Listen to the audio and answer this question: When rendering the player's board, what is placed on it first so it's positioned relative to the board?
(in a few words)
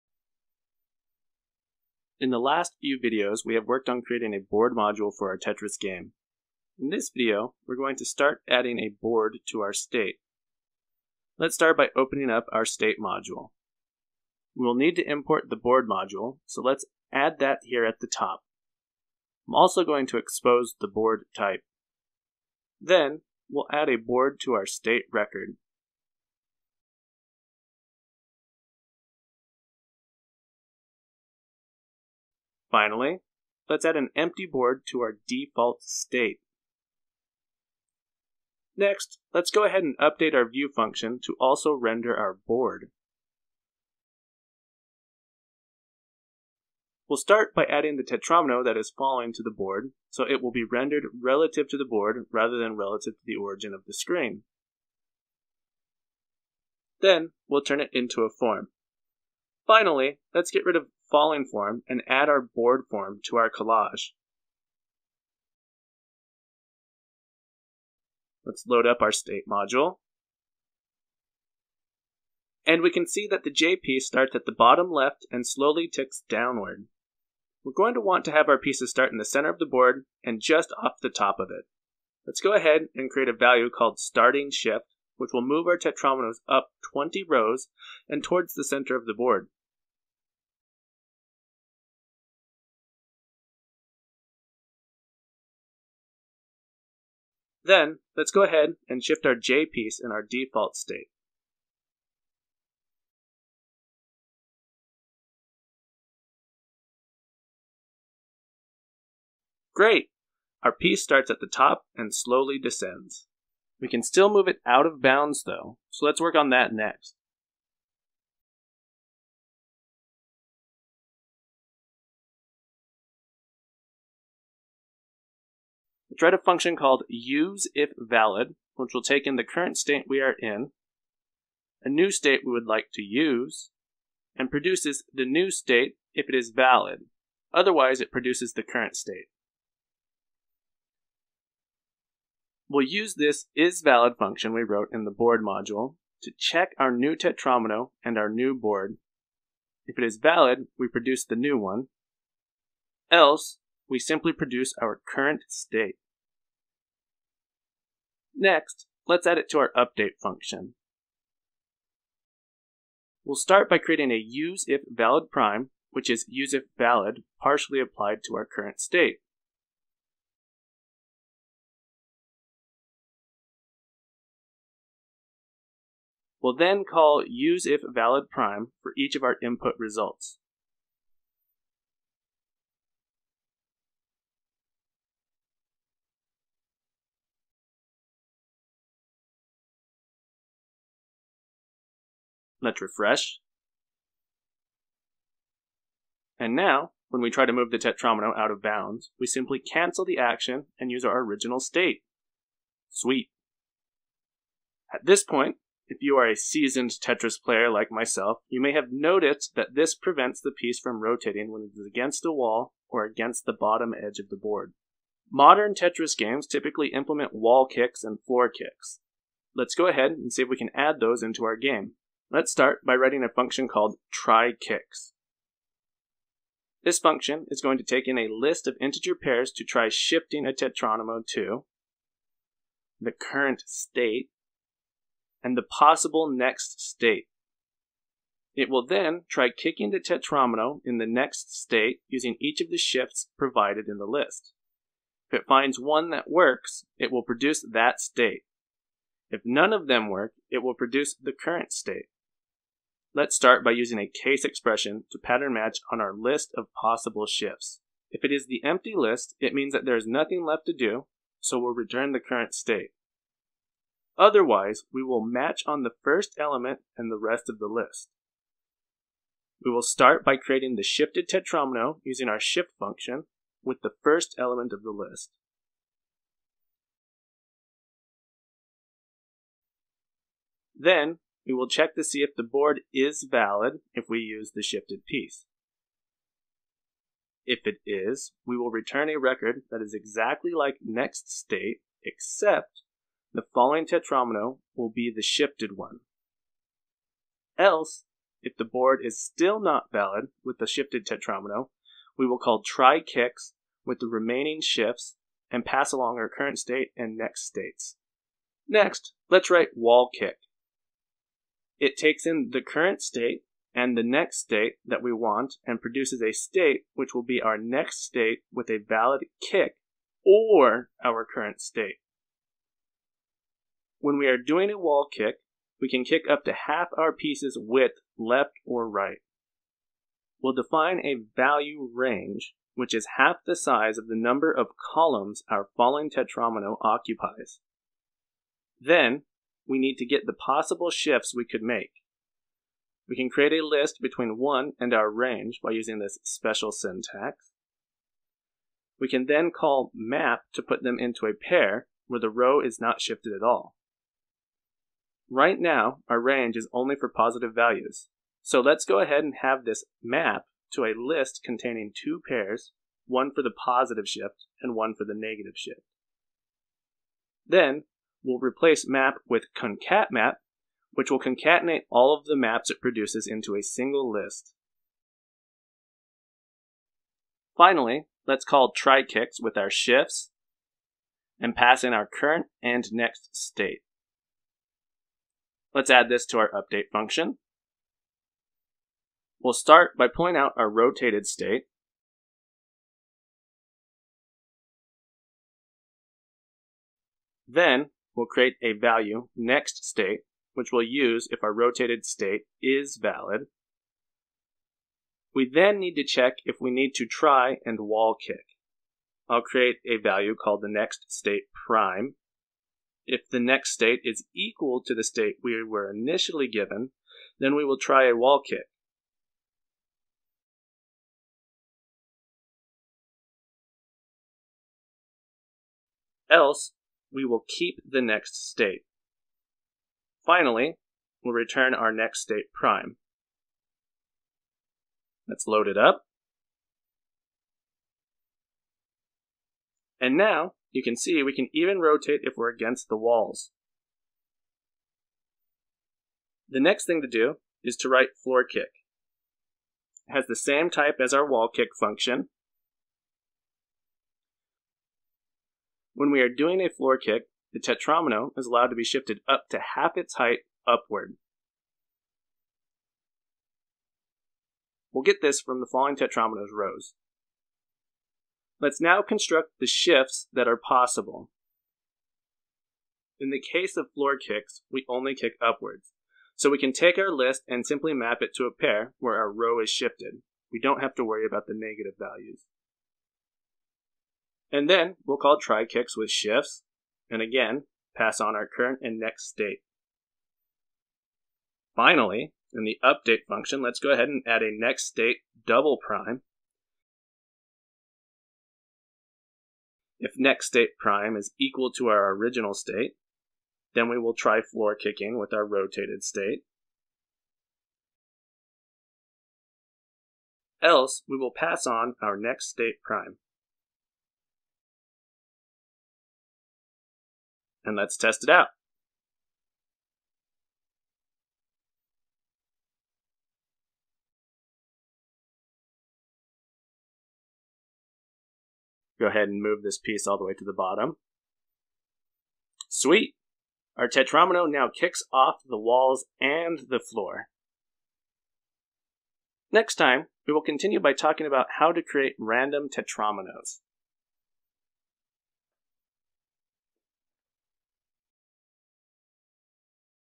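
The falling tetromino.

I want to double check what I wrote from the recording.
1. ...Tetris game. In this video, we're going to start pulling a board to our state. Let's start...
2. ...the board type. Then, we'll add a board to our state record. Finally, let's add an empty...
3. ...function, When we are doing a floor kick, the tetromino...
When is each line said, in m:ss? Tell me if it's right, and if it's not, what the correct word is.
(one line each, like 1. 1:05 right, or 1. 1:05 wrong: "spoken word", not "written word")
1. 0:05 wrong: "adding", not "pulling"
2. 0:20 right
3. 7:31 right.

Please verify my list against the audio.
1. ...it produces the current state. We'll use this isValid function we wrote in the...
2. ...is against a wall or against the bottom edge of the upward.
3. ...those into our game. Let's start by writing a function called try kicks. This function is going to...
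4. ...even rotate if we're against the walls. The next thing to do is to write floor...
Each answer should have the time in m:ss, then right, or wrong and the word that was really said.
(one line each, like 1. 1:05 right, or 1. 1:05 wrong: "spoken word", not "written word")
1. 2:18 right
2. 3:31 wrong: "board", not "upward"
3. 3:40 right
4. 7:21 right.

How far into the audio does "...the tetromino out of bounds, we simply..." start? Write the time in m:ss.
3:17.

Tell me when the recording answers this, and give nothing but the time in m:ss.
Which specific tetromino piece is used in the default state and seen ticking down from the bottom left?
1:13.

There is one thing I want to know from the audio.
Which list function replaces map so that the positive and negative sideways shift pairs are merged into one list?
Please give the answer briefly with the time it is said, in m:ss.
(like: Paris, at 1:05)
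concat_map, at 6:09.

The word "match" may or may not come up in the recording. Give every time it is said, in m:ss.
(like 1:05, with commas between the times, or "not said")
4:15, 4:25.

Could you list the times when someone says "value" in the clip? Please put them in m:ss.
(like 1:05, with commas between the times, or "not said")
1:23, 5:31, 5:57, 6:38, 6:50, 8:01.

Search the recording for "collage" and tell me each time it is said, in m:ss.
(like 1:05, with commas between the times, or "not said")
1:03.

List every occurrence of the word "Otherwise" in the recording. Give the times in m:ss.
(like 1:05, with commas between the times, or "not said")
2:17, 4:24.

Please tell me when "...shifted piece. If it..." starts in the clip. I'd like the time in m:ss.
4:44.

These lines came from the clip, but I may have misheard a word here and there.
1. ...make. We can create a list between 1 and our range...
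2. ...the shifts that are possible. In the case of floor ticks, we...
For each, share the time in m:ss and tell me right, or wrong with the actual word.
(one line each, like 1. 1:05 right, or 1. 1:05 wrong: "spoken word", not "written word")
1. 5:41 right
2. 7:49 wrong: "kicks", not "ticks".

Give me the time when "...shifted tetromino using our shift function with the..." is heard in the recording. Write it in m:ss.
4:30.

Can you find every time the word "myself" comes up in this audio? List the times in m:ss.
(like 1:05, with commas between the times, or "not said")
3:27.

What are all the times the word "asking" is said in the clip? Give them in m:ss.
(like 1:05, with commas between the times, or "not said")
not said.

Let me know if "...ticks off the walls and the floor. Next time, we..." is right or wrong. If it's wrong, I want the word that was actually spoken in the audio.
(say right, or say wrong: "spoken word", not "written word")
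wrong: "kicks", not "ticks".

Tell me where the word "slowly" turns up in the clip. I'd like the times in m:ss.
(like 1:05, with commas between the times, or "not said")
1:15, 1:52.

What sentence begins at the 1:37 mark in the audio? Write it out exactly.
Then, let's go ahead and shift our J piece in our default state.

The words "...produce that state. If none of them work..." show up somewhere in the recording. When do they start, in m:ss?
4:07.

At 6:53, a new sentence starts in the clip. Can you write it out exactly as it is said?
If the next state is equal to the state we were initially given, then we will try a wall kick.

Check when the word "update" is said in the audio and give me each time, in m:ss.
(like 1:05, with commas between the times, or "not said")
0:39, 2:39, 6:26, 8:12.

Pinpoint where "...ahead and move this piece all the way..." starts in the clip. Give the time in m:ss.
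8:49.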